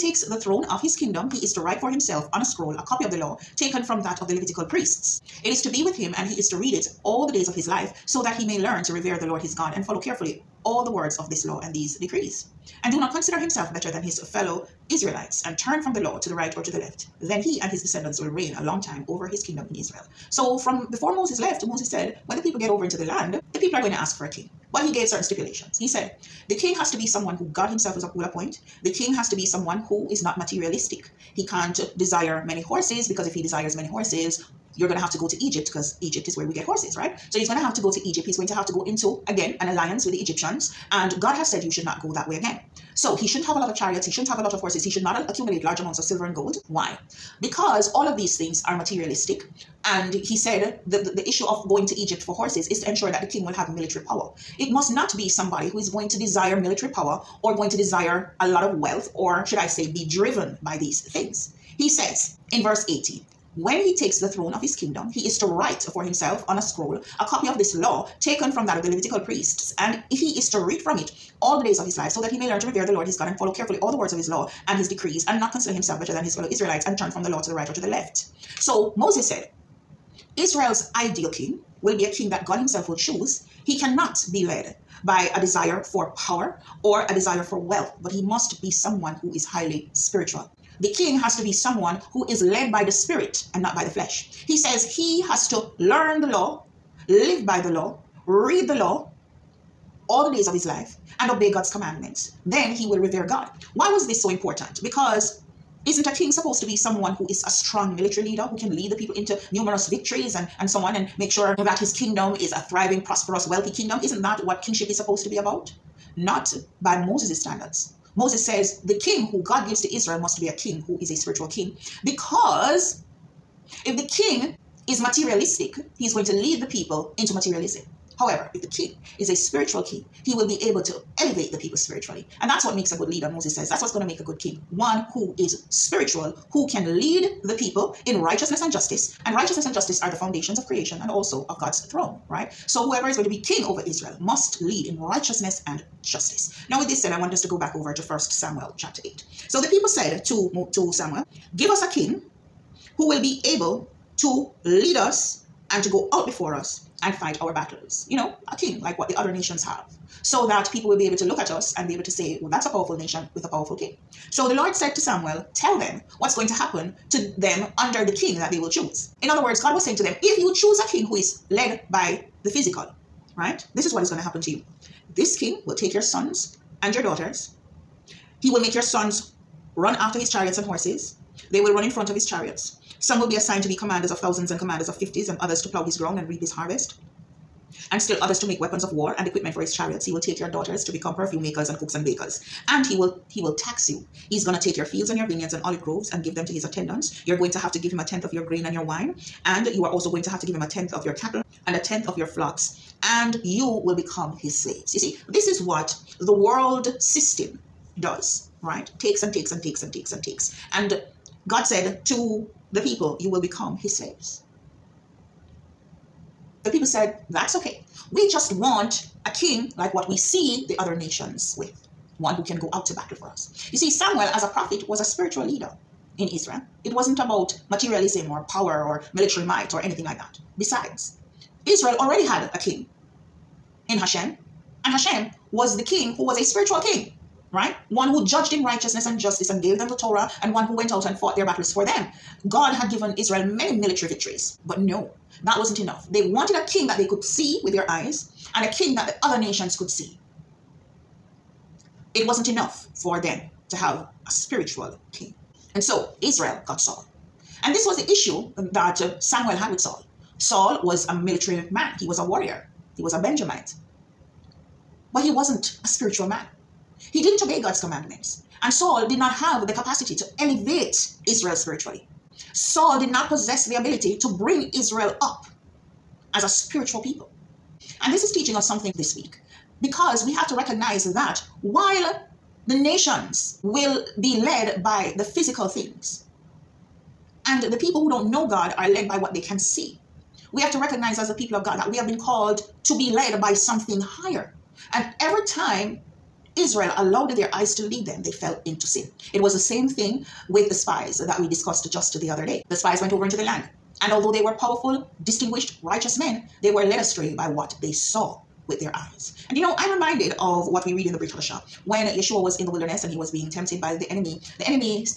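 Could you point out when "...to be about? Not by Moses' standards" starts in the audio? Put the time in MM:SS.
01:55.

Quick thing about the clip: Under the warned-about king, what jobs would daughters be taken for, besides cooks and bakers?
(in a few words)
Perfume makers.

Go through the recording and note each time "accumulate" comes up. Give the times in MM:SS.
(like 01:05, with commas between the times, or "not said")
00:45.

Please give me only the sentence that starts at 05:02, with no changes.
The spies went over into the land.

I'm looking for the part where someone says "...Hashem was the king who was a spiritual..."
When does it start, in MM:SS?
03:54.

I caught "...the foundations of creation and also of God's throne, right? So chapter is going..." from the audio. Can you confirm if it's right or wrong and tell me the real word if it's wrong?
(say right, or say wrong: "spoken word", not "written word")
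wrong: "whoever", not "chapter".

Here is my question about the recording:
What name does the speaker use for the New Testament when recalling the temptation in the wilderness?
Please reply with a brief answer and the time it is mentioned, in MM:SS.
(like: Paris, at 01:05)
Brit Hadashah, at 05:11.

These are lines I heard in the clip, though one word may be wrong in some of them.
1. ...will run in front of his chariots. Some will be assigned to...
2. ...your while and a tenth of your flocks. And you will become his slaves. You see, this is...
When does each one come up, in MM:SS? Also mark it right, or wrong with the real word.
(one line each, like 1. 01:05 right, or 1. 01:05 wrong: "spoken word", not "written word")
1. 03:01 right
2. 03:21 wrong: "cattle", not "while".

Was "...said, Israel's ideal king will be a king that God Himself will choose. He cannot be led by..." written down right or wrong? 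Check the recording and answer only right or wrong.
right.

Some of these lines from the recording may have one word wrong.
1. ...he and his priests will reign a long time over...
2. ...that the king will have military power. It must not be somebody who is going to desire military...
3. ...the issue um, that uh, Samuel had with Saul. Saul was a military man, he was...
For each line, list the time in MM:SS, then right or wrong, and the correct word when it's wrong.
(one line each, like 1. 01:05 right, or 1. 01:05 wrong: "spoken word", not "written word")
1. 00:17 wrong: "descendants", not "priests"
2. 00:53 right
3. 04:17 right.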